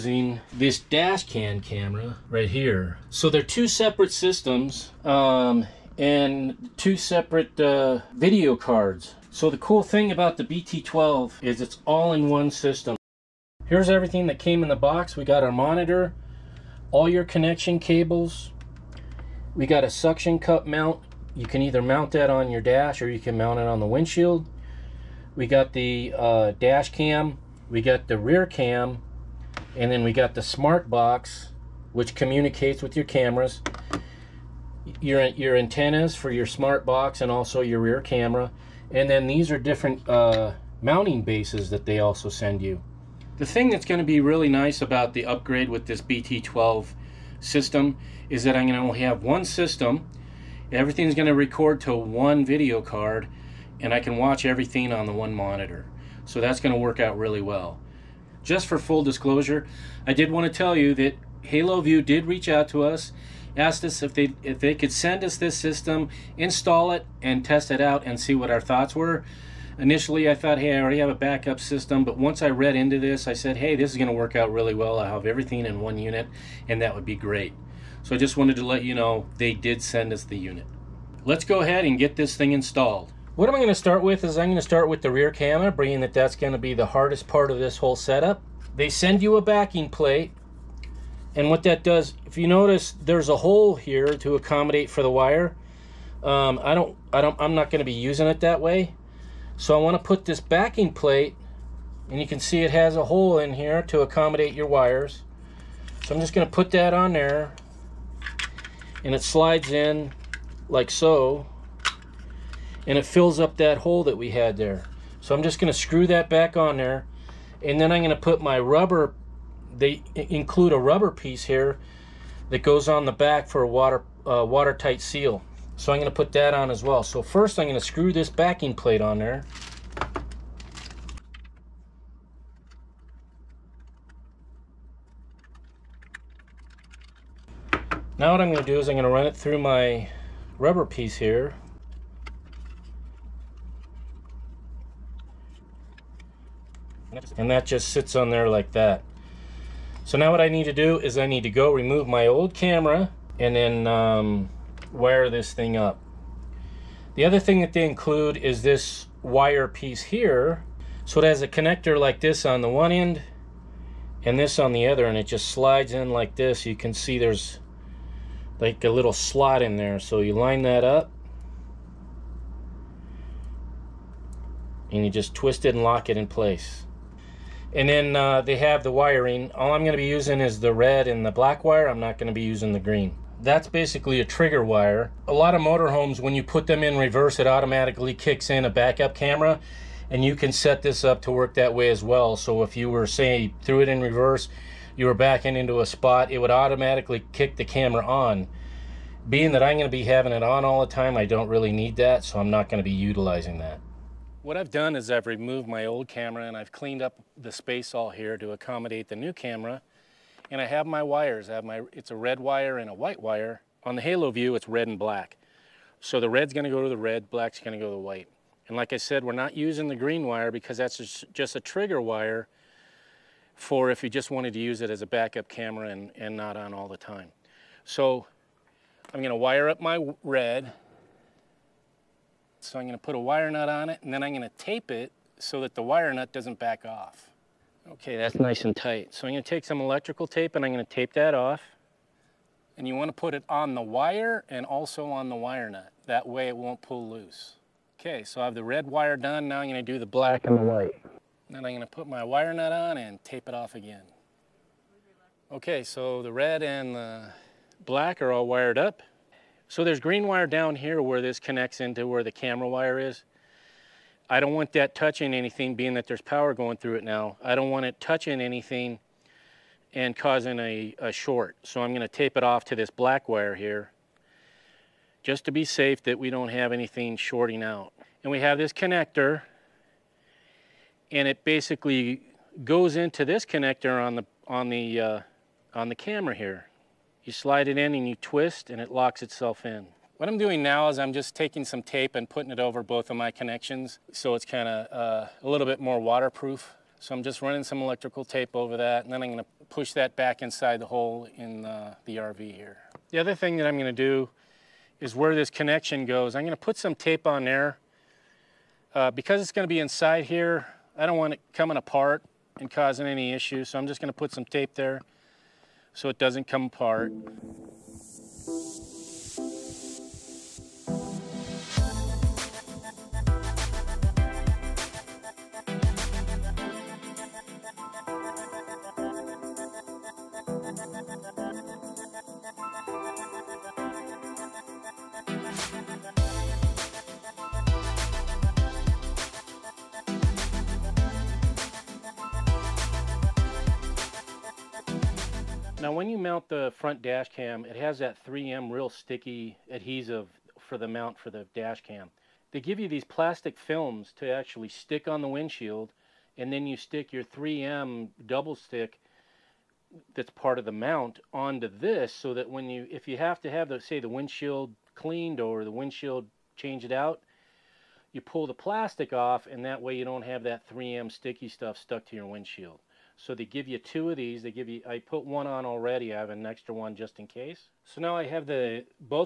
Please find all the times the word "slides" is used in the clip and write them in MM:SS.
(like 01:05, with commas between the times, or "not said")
01:49, 02:45, 04:47.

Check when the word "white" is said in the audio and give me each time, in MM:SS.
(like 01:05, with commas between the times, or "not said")
03:32, 03:37, 04:10.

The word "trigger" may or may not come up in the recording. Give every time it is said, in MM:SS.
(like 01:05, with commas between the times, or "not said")
03:04, 03:41.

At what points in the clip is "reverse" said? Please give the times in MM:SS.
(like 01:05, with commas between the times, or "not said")
03:06, 03:14.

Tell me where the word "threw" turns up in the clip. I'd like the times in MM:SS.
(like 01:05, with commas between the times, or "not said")
03:13.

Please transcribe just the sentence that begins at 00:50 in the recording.
Everything's going to record to one video card, and I can watch everything on the one monitor.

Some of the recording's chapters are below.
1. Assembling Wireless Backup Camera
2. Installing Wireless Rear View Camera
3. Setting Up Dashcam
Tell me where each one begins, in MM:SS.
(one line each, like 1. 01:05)
1. 01:20
2. 03:23
3. 05:45.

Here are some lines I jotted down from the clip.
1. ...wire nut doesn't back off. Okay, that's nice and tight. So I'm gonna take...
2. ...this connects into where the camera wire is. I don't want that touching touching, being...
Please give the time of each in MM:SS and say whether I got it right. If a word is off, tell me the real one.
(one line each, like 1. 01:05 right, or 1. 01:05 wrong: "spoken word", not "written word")
1. 03:55 right
2. 04:21 wrong: "anything", not "touching".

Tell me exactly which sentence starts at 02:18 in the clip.
Now what I'm going to do is I'm going to run it through my rubber piece here.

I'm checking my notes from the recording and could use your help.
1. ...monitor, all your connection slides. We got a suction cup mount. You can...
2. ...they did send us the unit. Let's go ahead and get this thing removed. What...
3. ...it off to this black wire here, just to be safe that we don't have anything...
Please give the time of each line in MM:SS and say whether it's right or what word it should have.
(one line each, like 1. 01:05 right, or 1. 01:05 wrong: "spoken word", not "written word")
1. 00:15 wrong: "cables", not "slides"
2. 01:19 wrong: "installed", not "removed"
3. 04:32 right.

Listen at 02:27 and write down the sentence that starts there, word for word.
And that just sits on there like that.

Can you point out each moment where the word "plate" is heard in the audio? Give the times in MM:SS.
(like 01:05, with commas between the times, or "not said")
01:29, 01:40, 02:08.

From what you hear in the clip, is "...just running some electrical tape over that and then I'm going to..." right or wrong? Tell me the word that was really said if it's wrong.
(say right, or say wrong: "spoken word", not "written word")
right.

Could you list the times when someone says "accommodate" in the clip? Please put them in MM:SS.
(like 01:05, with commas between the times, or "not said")
01:34, 01:44, 03:28.